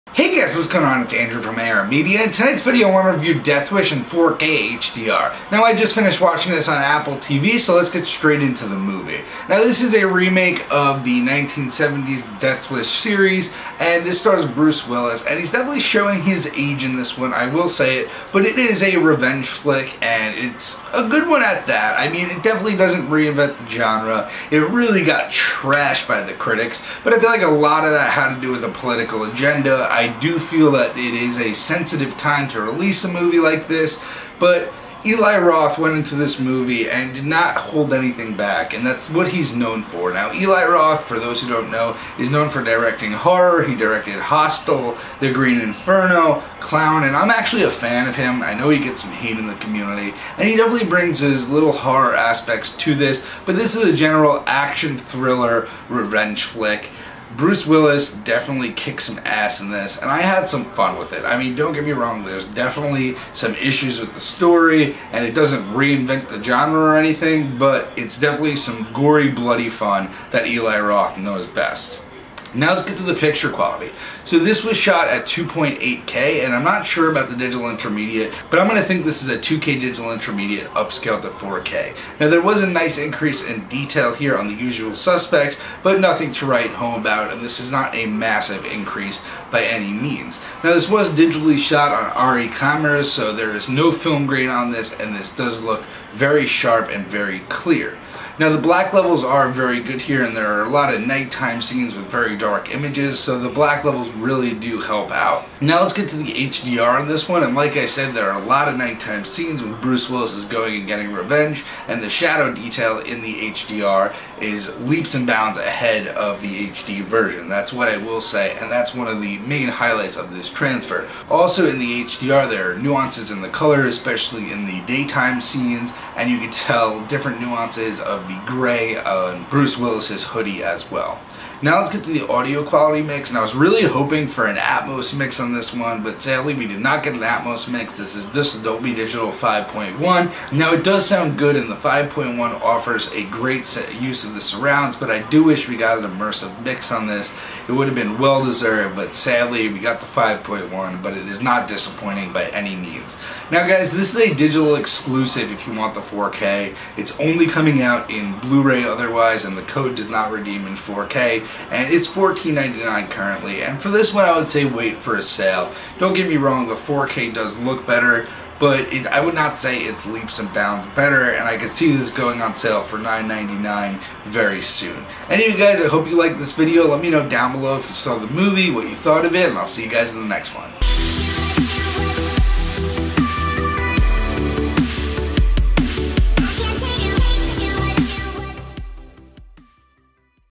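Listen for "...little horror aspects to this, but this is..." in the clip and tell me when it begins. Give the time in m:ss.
0:51.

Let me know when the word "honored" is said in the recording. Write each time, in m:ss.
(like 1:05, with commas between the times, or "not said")
not said.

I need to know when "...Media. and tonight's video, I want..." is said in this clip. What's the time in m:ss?
0:01.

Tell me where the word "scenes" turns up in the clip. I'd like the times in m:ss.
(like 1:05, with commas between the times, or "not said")
1:41, 1:49, 2:05.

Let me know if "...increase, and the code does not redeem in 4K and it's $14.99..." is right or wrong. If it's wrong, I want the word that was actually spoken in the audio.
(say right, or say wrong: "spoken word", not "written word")
wrong: "otherwise", not "increase".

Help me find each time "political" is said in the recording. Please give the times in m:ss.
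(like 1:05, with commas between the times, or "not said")
0:28.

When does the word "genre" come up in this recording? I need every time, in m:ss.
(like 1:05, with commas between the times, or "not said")
0:23, 1:06.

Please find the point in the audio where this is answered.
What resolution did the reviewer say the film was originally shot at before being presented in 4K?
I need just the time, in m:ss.
1:15.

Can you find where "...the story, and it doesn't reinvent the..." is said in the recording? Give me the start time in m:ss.
1:04.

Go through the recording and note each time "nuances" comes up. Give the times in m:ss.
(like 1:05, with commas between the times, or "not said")
2:02, 2:07.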